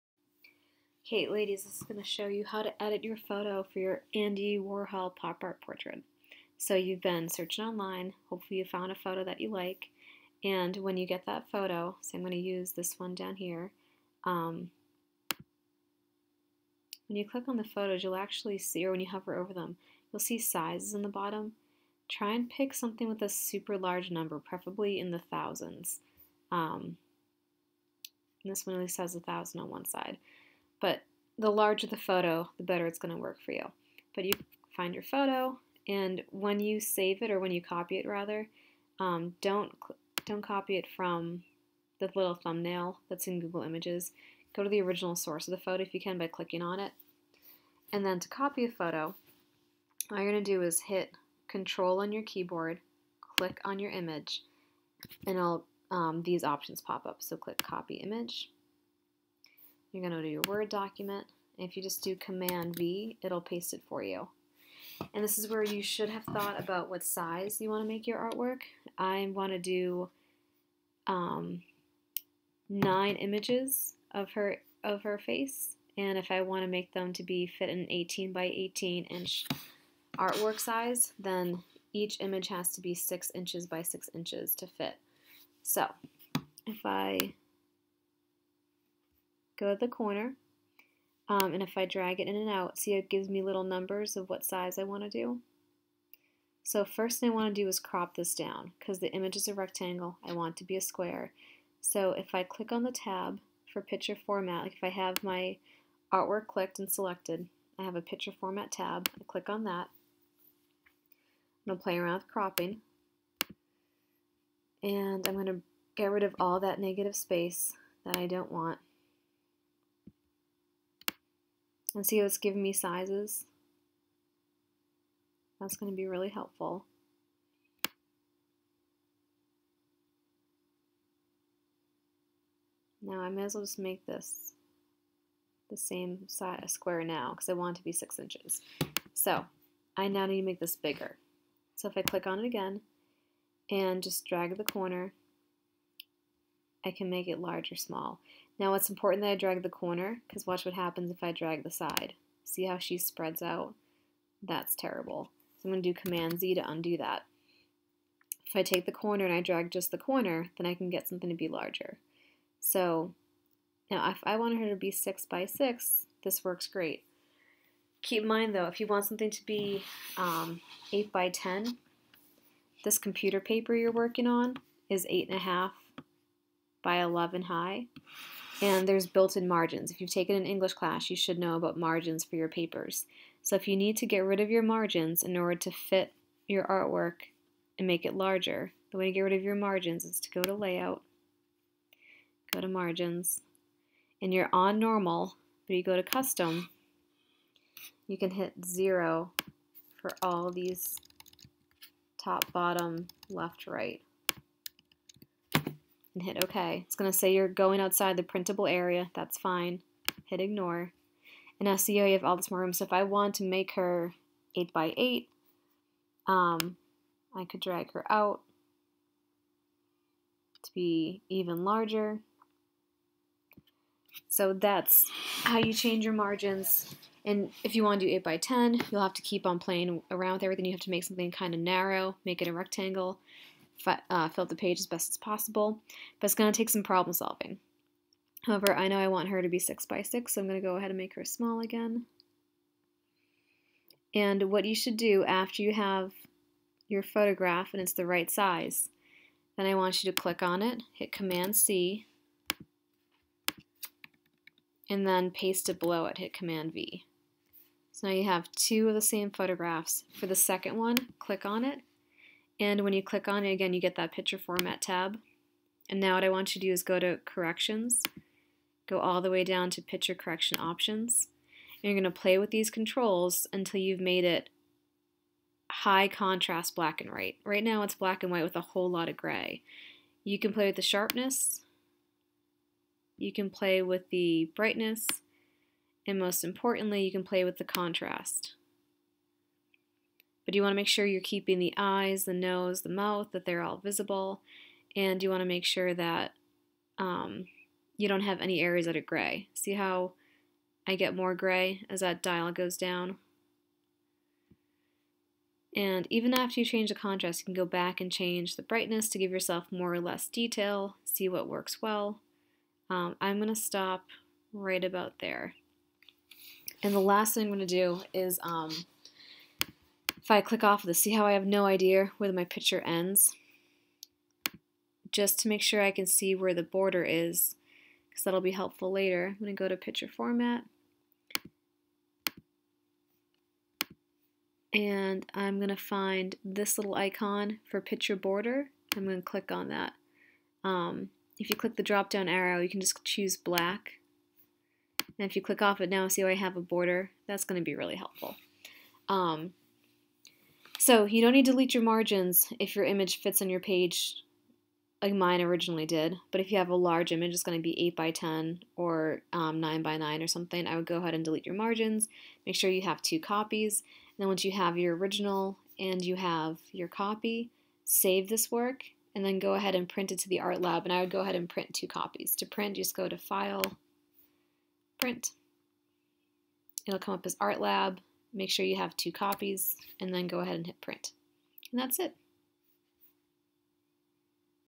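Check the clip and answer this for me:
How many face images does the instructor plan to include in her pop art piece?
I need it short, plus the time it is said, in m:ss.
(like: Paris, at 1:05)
9, at 1:12.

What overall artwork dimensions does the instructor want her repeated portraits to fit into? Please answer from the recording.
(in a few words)
18 by 18 inches.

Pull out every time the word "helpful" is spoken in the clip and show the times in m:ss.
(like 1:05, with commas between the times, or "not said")
2:06, 5:28, 5:47.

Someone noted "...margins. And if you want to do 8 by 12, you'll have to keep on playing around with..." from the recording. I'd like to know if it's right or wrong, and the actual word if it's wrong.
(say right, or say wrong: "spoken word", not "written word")
wrong: "10", not "12".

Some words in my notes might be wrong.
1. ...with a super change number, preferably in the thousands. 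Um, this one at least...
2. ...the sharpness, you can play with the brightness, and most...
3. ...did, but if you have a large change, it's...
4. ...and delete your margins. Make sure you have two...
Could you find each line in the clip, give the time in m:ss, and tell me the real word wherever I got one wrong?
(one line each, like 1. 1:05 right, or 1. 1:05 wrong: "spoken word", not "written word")
1. 0:23 wrong: "large", not "change"
2. 4:40 right
3. 5:55 wrong: "image", not "change"
4. 6:01 right.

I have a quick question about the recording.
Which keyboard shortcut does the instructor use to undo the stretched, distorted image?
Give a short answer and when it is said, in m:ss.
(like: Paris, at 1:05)
Command Z, at 2:35.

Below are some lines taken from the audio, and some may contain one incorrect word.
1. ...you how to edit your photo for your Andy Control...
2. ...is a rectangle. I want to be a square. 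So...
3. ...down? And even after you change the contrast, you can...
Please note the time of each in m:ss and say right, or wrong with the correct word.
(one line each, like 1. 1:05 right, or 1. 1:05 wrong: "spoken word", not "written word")
1. 0:02 wrong: "Warhol", not "Control"
2. 1:39 right
3. 5:02 right.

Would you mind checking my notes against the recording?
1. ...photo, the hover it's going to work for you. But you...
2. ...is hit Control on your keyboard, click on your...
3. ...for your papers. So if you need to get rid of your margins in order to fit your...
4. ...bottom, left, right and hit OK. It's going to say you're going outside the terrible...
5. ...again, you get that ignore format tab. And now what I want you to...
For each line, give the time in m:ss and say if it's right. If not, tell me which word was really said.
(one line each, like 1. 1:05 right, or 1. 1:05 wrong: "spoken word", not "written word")
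1. 0:31 wrong: "better", not "hover"
2. 0:50 right
3. 3:02 right
4. 3:22 wrong: "printable", not "terrible"
5. 4:23 wrong: "picture", not "ignore".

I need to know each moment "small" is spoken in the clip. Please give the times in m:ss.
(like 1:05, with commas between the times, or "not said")
2:27, 4:01.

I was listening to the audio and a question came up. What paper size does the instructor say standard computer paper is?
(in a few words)
8.5 by 11.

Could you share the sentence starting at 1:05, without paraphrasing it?
And this is where you should have thought about what size you want to make your artwork.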